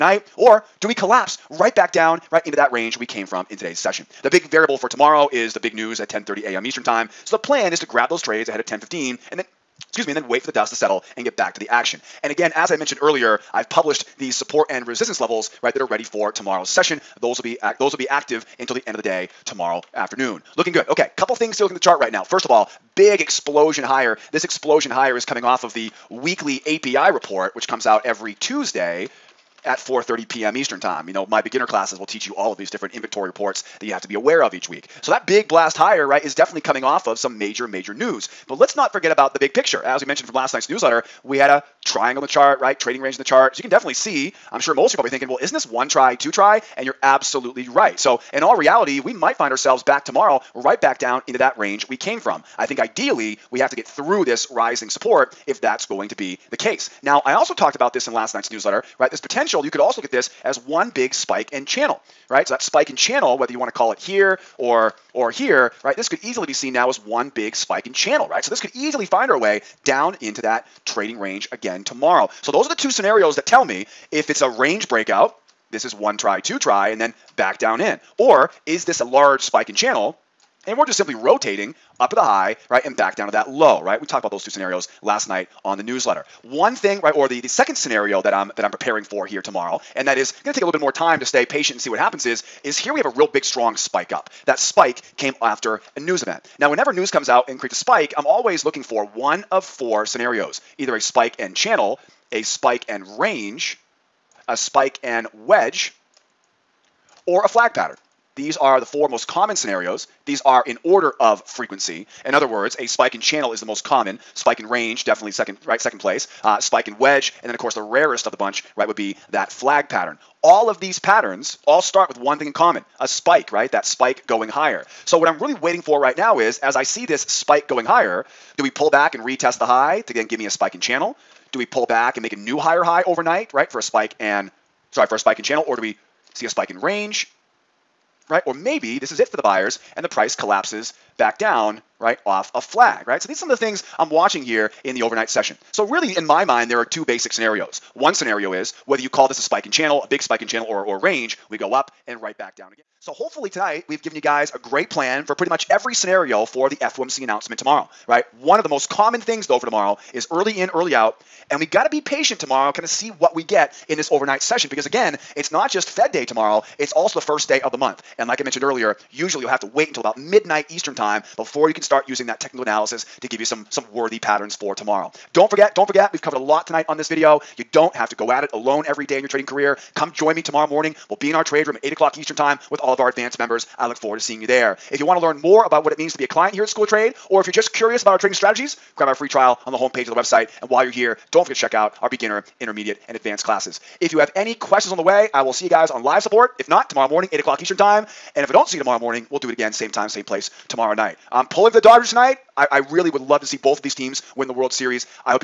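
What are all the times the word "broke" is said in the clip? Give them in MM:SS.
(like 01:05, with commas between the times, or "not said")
not said.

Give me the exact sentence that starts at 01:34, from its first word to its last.
That spike came after a news event.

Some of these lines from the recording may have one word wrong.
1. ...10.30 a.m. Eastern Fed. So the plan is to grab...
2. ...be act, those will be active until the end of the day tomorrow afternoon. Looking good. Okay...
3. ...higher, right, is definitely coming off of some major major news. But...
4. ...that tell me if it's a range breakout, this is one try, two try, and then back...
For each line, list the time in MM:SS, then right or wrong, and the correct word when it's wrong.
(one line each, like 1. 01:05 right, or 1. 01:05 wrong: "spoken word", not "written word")
1. 00:06 wrong: "Time", not "Fed"
2. 00:17 right
3. 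00:35 right
4. 01:13 right.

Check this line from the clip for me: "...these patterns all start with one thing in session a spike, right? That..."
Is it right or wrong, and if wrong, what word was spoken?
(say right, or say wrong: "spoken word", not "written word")
wrong: "common", not "session".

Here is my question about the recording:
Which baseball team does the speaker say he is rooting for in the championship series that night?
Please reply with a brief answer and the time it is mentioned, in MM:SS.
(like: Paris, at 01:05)
Dodgers, at 03:21.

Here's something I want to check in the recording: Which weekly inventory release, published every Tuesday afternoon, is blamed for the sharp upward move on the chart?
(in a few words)
API report.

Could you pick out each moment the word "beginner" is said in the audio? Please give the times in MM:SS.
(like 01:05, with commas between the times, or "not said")
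00:31, 03:12.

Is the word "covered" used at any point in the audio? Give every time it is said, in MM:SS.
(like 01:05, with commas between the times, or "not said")
02:56.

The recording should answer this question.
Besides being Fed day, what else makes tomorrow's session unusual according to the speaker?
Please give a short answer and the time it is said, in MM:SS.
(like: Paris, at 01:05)
First day of the month, at 02:47.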